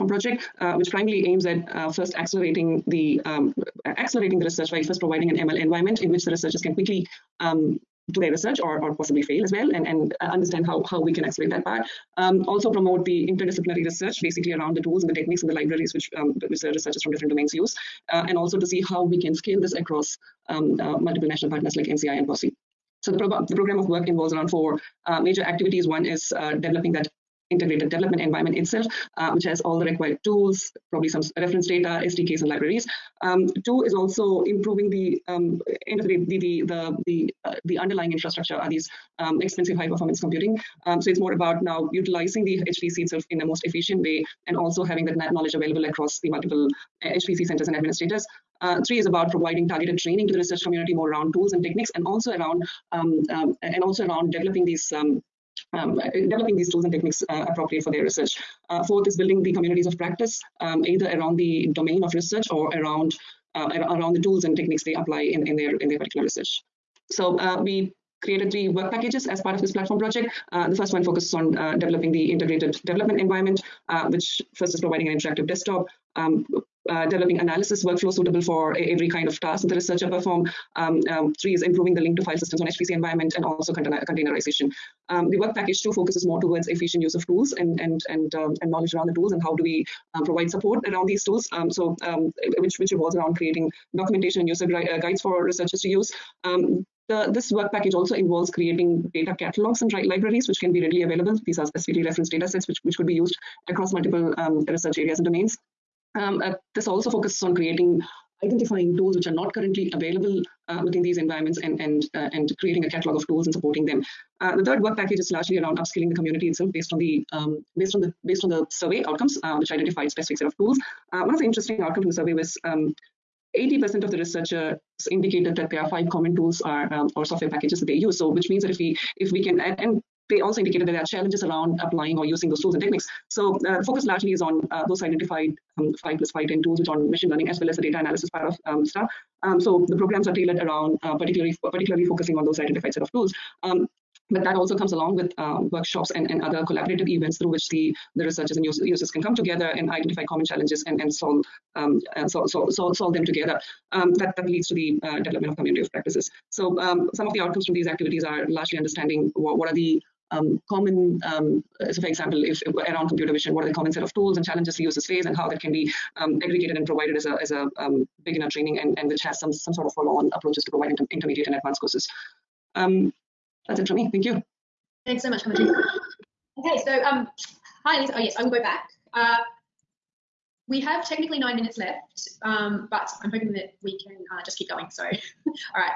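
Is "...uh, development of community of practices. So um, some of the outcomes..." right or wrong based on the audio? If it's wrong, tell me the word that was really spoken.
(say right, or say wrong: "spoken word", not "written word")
right.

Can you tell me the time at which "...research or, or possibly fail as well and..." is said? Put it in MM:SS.
00:08.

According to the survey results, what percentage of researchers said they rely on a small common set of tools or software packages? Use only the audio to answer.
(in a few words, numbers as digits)
80%.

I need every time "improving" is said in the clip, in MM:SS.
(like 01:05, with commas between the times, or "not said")
00:34, 01:21.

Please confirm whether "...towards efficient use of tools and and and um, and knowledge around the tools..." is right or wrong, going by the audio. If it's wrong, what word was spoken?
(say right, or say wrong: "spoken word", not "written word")
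right.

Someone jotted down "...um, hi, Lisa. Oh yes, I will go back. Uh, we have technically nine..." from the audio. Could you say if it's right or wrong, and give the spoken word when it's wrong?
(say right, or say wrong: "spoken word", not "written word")
right.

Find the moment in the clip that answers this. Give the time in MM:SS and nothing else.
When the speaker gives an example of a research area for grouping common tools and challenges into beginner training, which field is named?
02:43.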